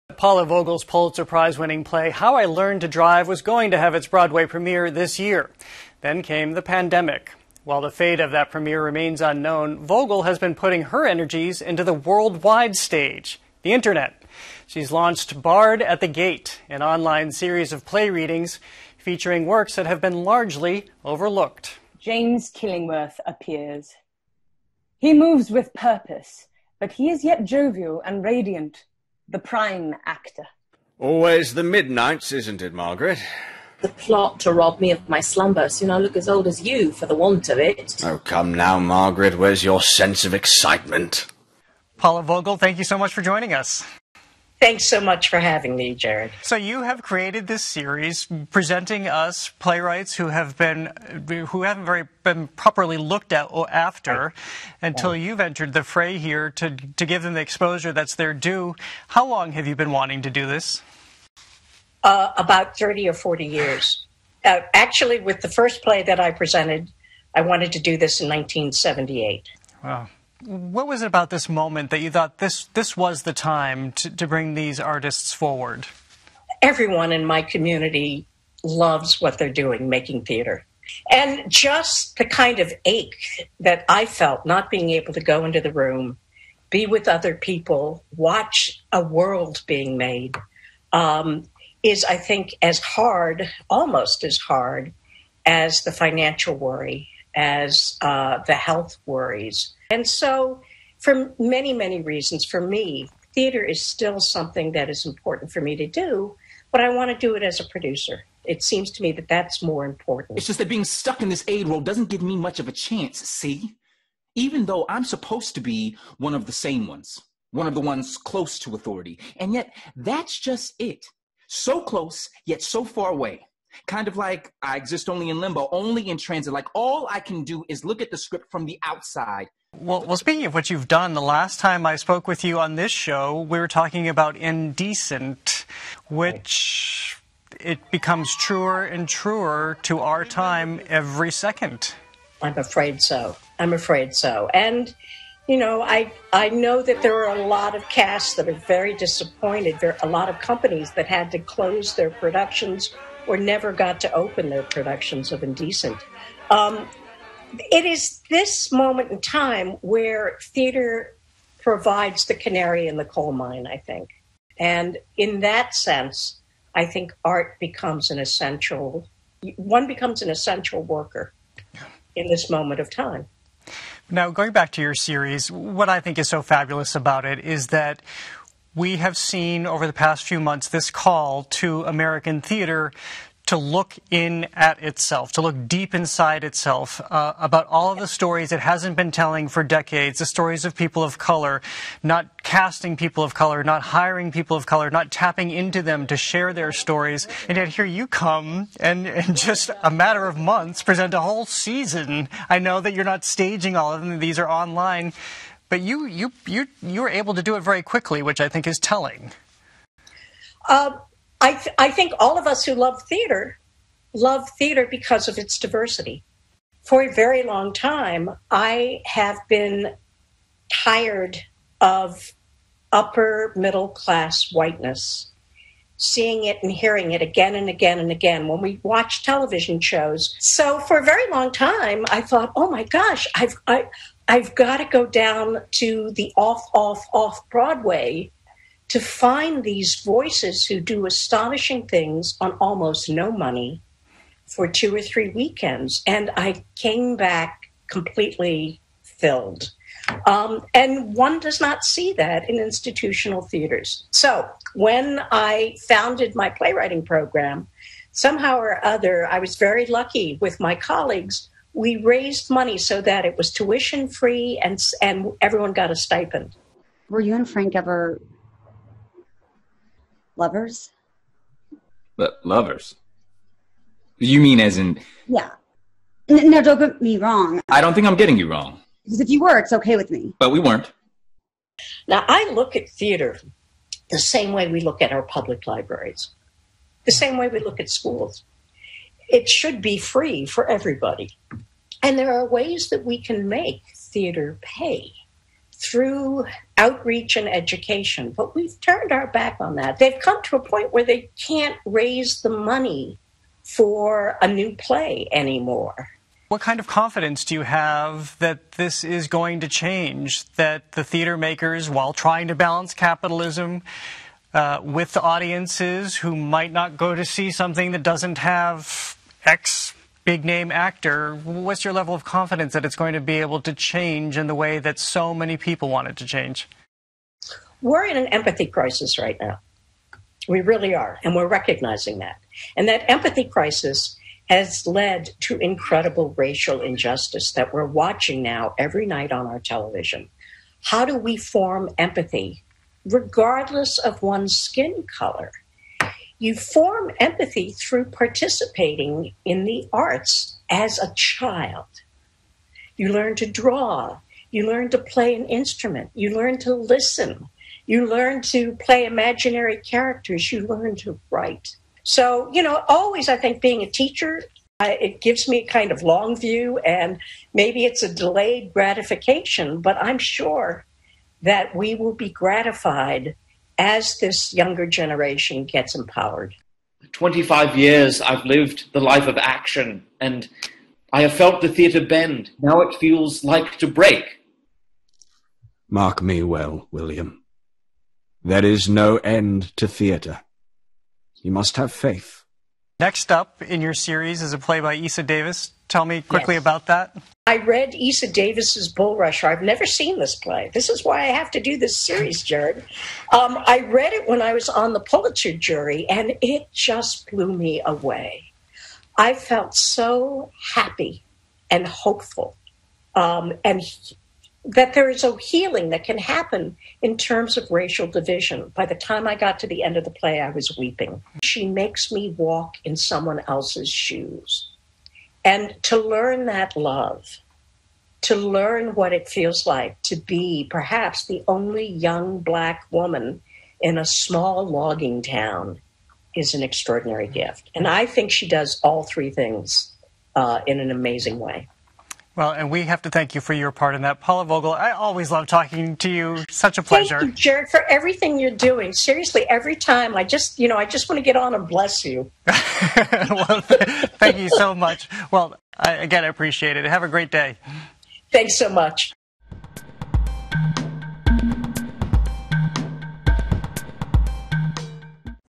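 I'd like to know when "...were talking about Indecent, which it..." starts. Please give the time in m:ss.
2:13.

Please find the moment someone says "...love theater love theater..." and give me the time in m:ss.
3:32.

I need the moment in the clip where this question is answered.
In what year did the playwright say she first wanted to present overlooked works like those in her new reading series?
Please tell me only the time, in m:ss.
1:08.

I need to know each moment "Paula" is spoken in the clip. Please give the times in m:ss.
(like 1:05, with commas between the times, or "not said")
0:00, 0:41, 7:24.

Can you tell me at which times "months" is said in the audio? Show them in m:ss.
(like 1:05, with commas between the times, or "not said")
3:00, 3:20.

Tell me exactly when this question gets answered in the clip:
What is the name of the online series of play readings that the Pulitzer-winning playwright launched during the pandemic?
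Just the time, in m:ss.
0:15.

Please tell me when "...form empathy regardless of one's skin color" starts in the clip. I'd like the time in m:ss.
5:41.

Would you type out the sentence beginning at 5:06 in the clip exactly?
What kind of confidence do you have that this is going to change?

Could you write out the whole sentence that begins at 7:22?
Well, and we have to thank you for your part in that.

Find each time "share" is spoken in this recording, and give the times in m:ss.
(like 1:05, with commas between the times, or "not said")
3:16.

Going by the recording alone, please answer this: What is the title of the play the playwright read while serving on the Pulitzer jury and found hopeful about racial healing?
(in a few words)
Bulrusher.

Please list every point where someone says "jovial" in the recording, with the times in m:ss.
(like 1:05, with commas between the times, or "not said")
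0:27.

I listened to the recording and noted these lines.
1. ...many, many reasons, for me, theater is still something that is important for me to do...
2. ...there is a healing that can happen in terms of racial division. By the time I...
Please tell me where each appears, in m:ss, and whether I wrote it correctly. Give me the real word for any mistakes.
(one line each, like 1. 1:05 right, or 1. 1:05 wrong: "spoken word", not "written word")
1. 1:41 right
2. 6:54 right.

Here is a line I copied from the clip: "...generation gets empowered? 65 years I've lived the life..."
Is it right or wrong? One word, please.
wrong.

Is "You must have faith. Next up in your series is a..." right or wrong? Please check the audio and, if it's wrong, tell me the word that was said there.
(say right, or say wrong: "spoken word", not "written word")
right.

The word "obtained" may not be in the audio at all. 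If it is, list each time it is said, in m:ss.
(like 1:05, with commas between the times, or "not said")
not said.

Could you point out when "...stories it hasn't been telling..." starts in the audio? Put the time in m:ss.
3:08.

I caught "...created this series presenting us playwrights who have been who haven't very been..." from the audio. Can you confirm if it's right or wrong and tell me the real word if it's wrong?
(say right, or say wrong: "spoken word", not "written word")
right.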